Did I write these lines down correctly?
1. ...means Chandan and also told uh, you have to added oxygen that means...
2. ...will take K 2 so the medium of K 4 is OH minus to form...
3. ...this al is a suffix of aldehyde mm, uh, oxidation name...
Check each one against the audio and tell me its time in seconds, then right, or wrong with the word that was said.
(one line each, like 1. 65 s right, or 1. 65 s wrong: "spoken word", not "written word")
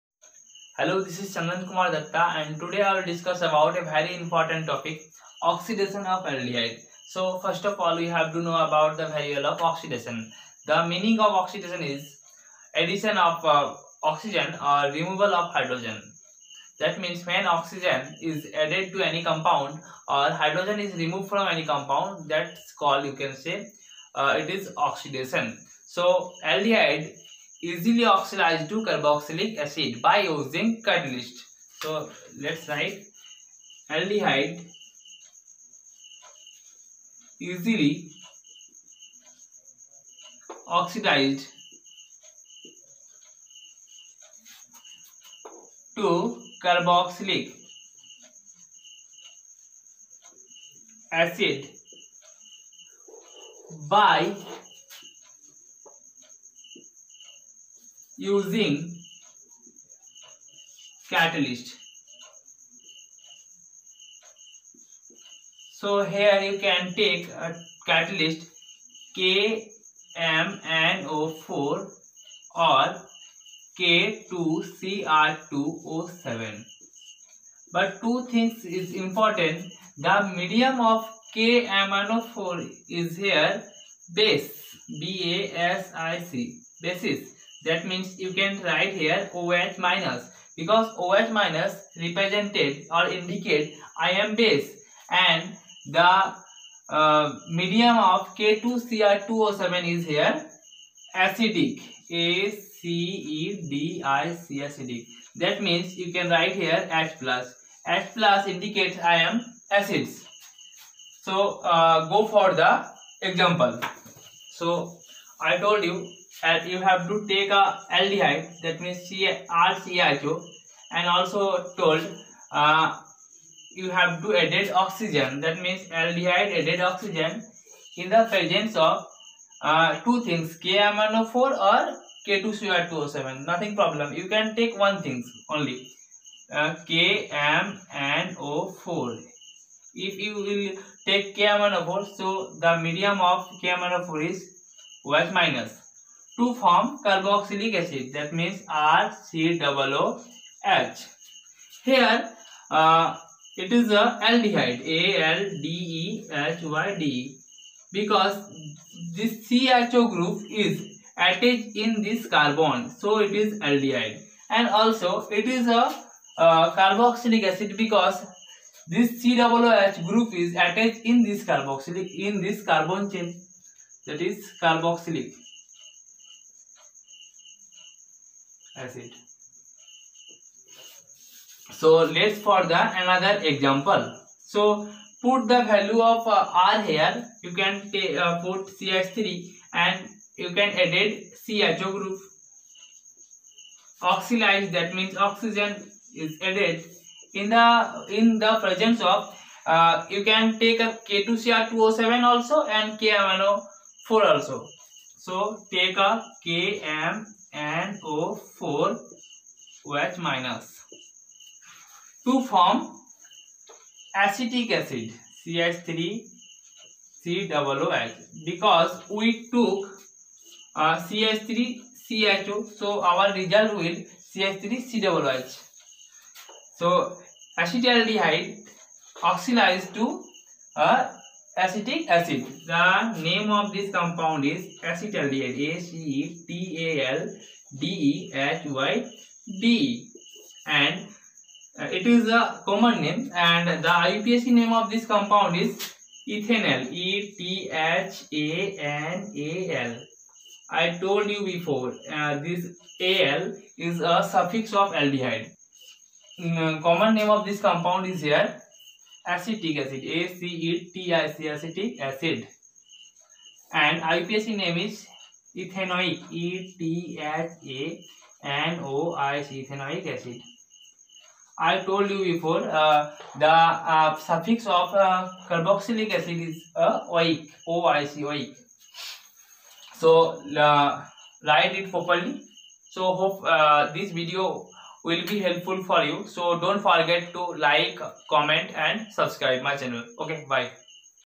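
1. 118 s wrong: "RCHO", not "Chandan"
2. 140 s wrong: "4", not "2"
3. 252 s wrong: "common", not "oxidation".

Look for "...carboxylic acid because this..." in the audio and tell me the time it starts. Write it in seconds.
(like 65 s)
166 s.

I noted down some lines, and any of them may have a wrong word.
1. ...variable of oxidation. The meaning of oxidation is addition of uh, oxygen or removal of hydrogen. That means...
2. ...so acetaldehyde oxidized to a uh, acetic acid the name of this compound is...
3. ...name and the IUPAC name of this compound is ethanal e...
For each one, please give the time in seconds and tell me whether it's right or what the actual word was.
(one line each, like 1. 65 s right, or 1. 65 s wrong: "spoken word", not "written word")
1. 9 s right
2. 226 s right
3. 243 s right.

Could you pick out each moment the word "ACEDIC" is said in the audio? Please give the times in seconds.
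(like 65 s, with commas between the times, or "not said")
102 s.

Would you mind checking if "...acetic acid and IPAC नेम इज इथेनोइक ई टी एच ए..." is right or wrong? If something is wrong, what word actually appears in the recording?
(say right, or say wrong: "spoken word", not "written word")
right.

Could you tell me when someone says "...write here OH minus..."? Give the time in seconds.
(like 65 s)
88 s.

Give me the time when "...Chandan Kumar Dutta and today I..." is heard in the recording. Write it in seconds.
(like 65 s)
1 s.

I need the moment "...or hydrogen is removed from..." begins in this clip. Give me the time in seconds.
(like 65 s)
20 s.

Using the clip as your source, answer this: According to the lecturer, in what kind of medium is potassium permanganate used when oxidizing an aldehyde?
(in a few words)
Basic.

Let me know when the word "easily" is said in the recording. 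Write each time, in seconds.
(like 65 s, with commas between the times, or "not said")
27 s, 37 s.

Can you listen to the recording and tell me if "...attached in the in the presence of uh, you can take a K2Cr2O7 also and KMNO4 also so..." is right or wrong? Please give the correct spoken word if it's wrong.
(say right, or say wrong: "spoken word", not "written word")
wrong: "added", not "attached".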